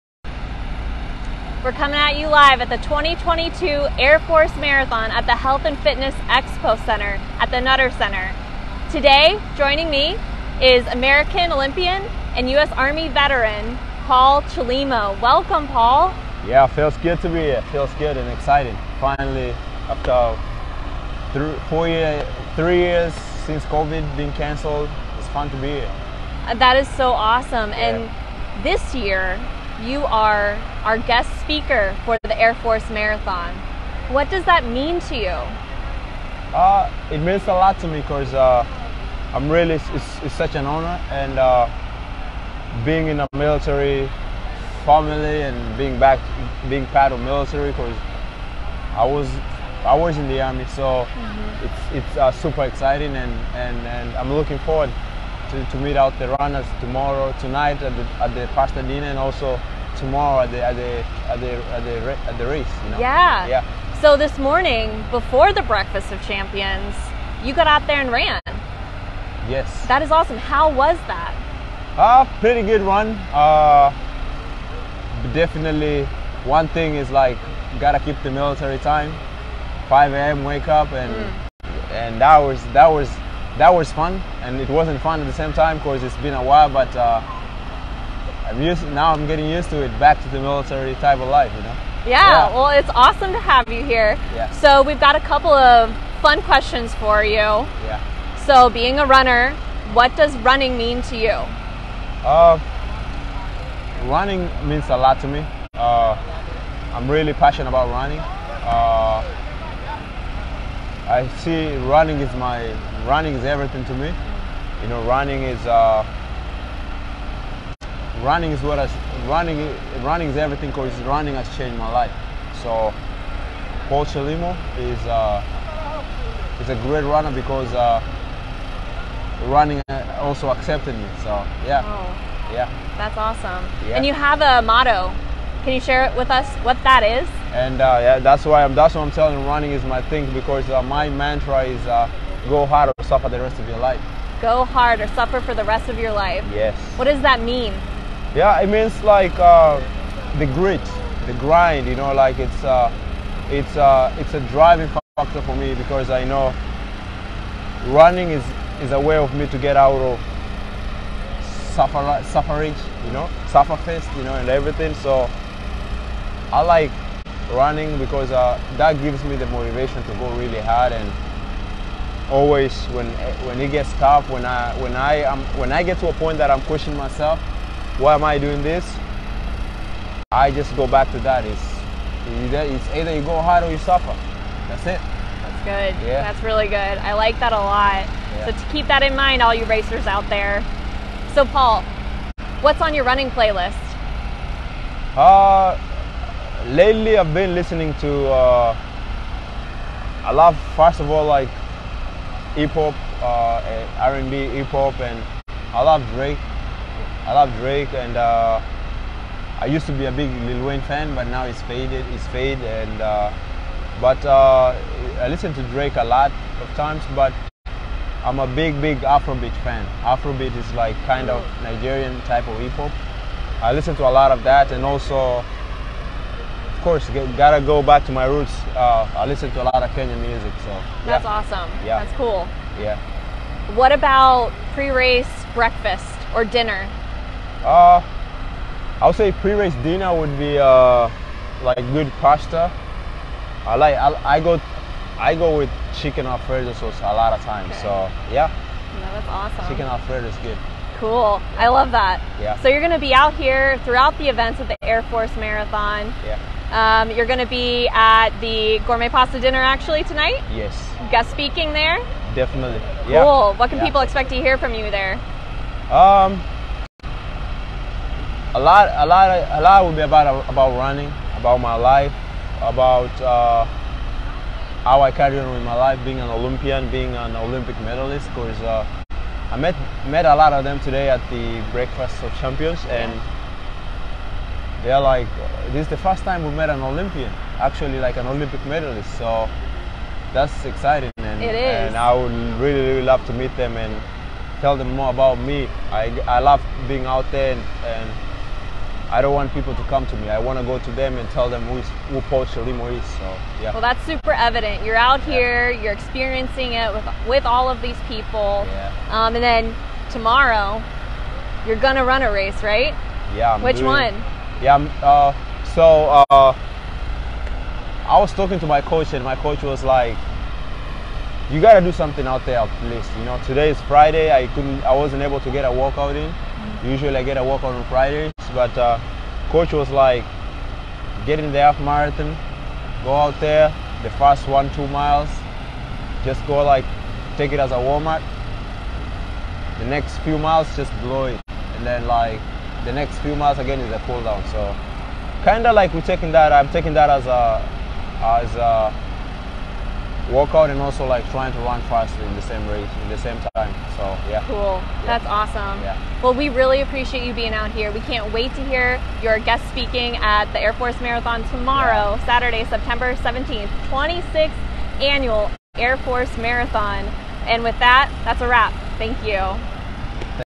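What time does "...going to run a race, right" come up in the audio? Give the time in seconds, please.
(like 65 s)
311 s.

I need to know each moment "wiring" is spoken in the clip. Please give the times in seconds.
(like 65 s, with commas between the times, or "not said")
not said.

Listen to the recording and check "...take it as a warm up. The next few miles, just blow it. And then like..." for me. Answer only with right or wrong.
right.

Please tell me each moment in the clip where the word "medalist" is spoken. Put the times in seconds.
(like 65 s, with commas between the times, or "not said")
277 s, 288 s.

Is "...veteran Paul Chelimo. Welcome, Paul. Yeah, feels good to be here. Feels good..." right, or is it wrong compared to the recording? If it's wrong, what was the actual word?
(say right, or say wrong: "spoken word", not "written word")
right.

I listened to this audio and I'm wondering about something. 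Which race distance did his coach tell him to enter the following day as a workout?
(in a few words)
Half marathon.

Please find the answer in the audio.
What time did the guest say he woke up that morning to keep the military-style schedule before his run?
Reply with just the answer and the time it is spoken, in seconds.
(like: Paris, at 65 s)
5 a.m., at 79 s.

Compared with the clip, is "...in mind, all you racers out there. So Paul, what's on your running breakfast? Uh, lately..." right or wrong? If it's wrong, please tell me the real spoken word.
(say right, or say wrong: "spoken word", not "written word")
wrong: "playlist", not "breakfast".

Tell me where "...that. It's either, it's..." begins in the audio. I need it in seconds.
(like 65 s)
181 s.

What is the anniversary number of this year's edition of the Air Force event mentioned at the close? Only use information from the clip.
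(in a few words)
26th.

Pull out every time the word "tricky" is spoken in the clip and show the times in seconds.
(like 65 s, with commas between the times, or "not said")
not said.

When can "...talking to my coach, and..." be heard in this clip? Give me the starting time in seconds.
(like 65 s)
318 s.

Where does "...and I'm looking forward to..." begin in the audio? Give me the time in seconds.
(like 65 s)
53 s.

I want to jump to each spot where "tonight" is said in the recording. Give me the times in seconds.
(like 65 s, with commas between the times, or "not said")
57 s, 260 s.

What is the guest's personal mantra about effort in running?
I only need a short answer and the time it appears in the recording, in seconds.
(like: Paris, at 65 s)
Go hard or suffer the rest of your life, at 142 s.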